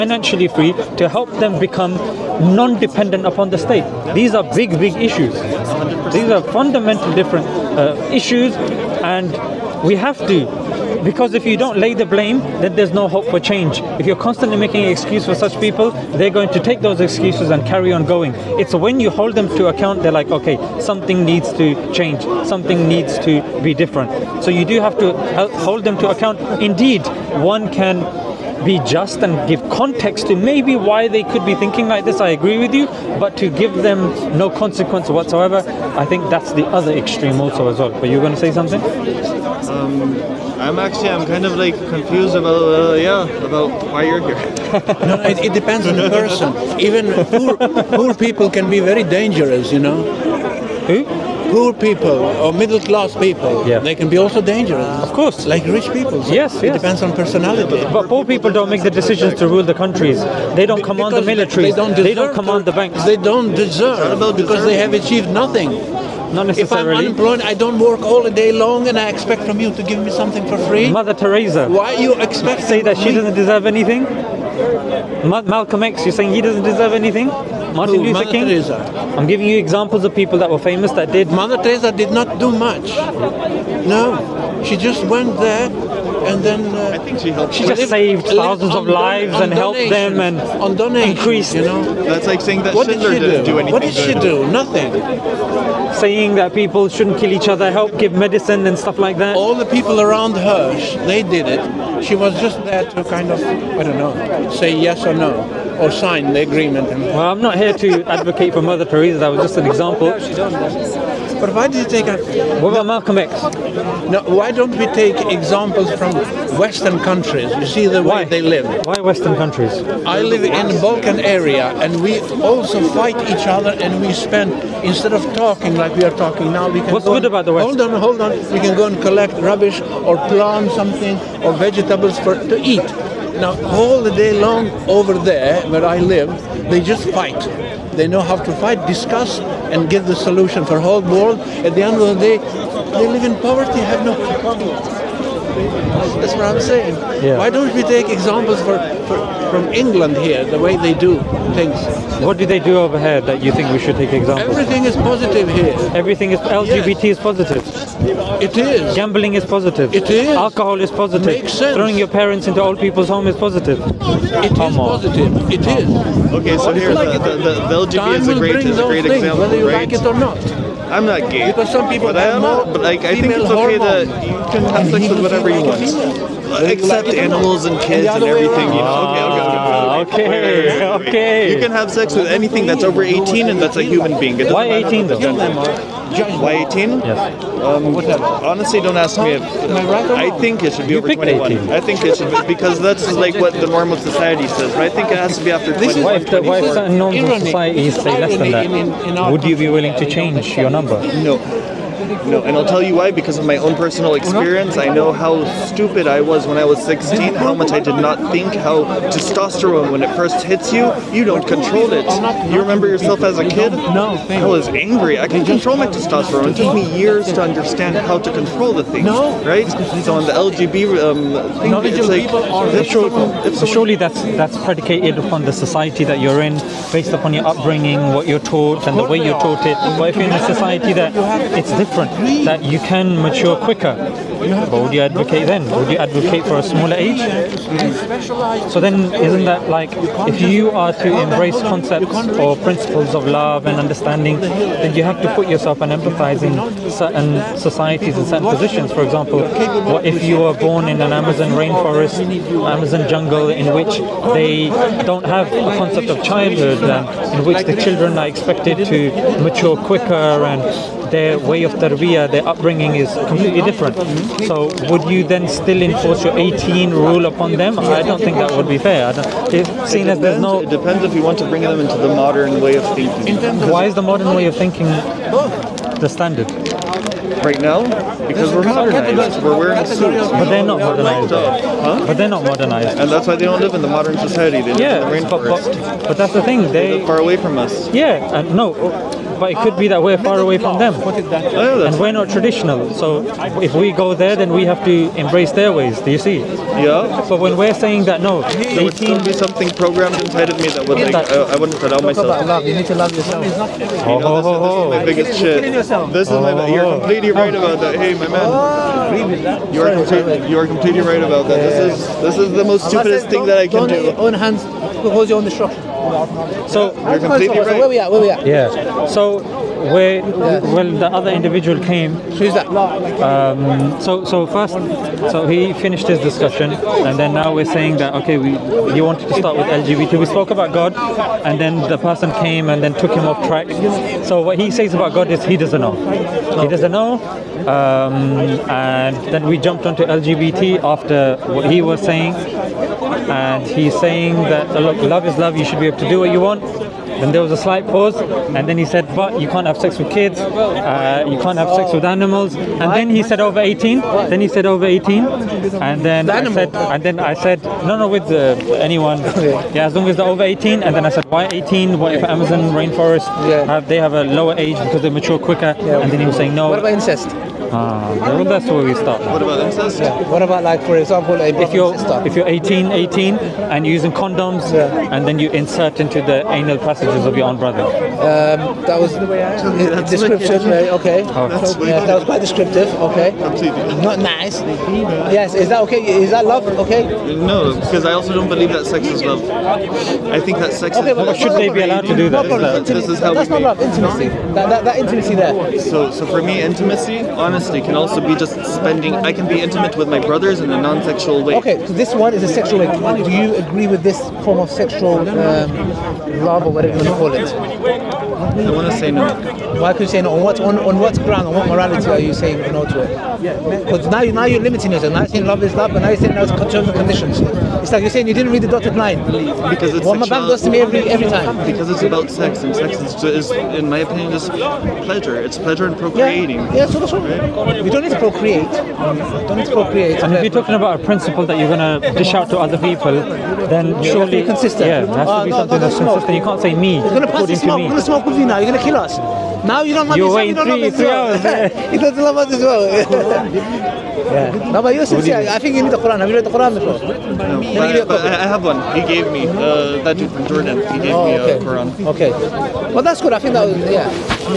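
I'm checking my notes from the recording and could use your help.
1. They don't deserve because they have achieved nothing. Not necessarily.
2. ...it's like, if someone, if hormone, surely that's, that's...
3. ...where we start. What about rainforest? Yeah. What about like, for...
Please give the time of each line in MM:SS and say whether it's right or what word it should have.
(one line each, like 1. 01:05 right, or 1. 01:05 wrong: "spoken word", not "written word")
1. 01:03 right
2. 03:41 wrong: "someone", not "hormone"
3. 06:08 wrong: "incest", not "rainforest".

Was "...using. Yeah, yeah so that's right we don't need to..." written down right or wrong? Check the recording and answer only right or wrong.
wrong.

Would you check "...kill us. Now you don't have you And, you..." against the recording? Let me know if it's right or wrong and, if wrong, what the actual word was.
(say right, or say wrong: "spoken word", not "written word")
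wrong: "Islam", not "And".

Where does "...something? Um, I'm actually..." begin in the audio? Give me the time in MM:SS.
00:38.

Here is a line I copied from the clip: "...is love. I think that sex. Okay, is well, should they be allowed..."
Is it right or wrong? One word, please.
right.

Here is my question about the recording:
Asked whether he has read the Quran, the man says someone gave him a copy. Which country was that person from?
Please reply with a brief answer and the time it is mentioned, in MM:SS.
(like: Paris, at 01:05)
Jordan, at 07:30.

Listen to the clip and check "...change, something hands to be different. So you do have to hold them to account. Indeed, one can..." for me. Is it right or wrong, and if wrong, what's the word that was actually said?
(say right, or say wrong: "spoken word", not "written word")
wrong: "needs", not "hands".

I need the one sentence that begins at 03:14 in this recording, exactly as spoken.
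But I think it has to be after 21.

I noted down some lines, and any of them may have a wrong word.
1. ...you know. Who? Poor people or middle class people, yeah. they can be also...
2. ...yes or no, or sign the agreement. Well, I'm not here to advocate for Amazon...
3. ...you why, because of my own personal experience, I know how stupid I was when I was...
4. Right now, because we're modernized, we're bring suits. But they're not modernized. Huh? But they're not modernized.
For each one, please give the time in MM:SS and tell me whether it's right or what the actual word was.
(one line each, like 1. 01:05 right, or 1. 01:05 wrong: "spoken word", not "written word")
1. 00:49 right
2. 01:44 wrong: "Mother", not "Amazon"
3. 03:22 right
4. 04:37 wrong: "wearing", not "bring".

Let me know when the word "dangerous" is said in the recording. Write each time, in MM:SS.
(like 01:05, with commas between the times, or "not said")
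00:49, 00:54.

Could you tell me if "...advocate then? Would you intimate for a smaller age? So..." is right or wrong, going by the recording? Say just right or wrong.
wrong.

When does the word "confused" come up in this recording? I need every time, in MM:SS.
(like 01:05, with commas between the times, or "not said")
00:41.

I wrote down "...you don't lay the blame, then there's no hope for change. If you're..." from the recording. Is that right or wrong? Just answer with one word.
right.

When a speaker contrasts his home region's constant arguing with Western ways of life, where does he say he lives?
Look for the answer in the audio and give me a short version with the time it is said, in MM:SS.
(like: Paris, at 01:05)
Balkan area, at 02:00.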